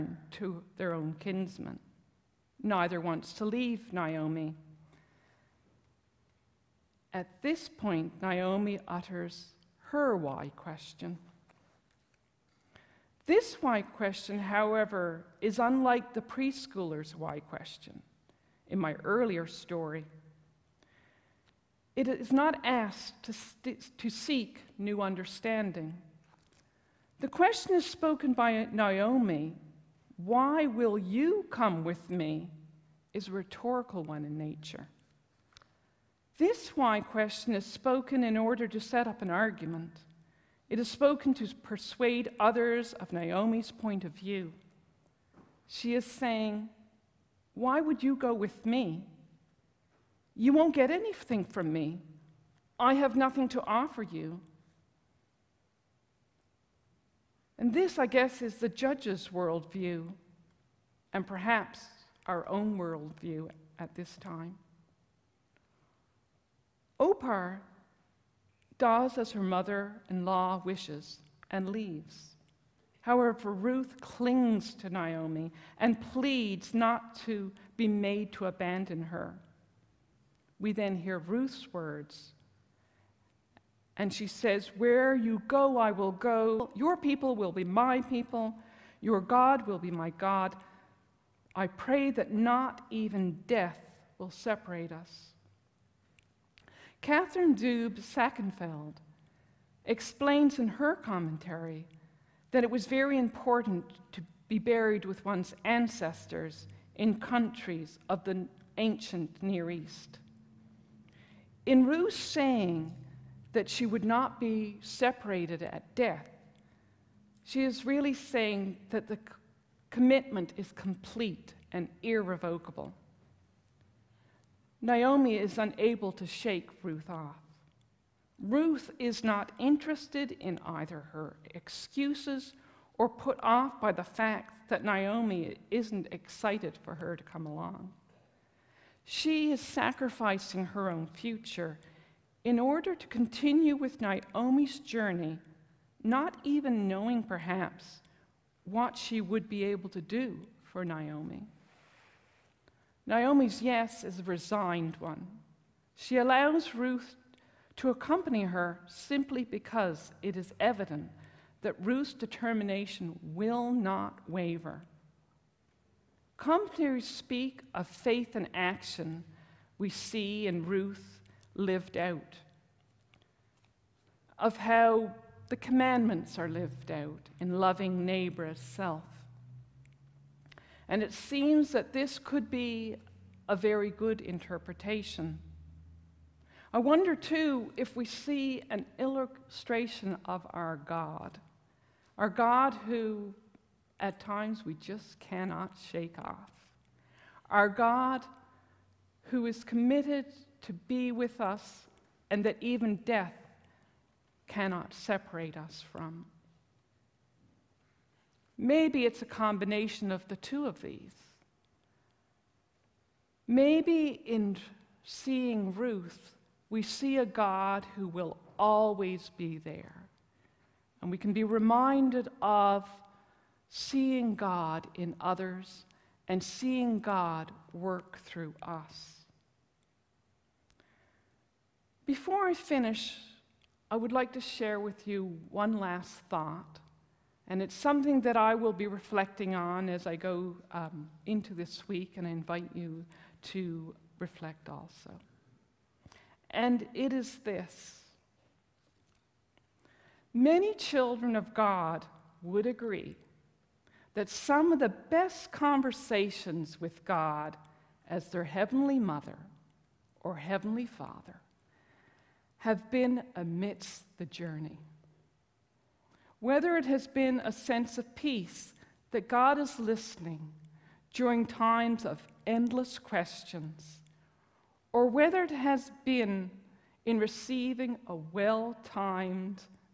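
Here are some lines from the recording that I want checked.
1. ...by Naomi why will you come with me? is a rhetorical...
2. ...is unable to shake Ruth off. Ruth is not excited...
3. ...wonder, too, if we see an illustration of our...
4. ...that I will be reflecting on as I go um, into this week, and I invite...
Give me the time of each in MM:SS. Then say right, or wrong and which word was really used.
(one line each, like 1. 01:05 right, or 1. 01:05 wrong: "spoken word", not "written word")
1. 00:28 right
2. 02:05 wrong: "interested", not "excited"
3. 03:06 right
4. 03:58 right.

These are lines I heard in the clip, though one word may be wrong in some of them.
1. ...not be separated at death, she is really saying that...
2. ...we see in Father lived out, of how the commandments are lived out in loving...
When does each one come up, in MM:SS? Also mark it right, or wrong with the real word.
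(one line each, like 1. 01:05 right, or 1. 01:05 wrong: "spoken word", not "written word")
1. 01:54 right
2. 02:49 wrong: "Ruth", not "Father".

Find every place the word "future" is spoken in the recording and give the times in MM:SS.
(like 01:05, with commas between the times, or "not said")
02:21.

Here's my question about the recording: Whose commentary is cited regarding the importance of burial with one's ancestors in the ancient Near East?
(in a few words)
Katharine Doob Sakenfeld.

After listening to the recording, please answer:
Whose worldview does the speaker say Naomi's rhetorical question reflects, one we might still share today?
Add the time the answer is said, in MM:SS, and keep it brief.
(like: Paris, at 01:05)
the judge's, at 00:58.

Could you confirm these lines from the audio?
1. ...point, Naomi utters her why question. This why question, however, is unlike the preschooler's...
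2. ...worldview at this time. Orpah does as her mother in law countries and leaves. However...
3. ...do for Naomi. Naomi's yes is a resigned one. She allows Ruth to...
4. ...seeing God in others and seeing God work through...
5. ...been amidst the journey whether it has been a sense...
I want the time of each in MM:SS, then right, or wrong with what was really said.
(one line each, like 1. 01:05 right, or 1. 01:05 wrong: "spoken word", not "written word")
1. 00:07 right
2. 01:02 wrong: "wishes", not "countries"
3. 02:30 right
4. 03:43 right
5. 04:22 right.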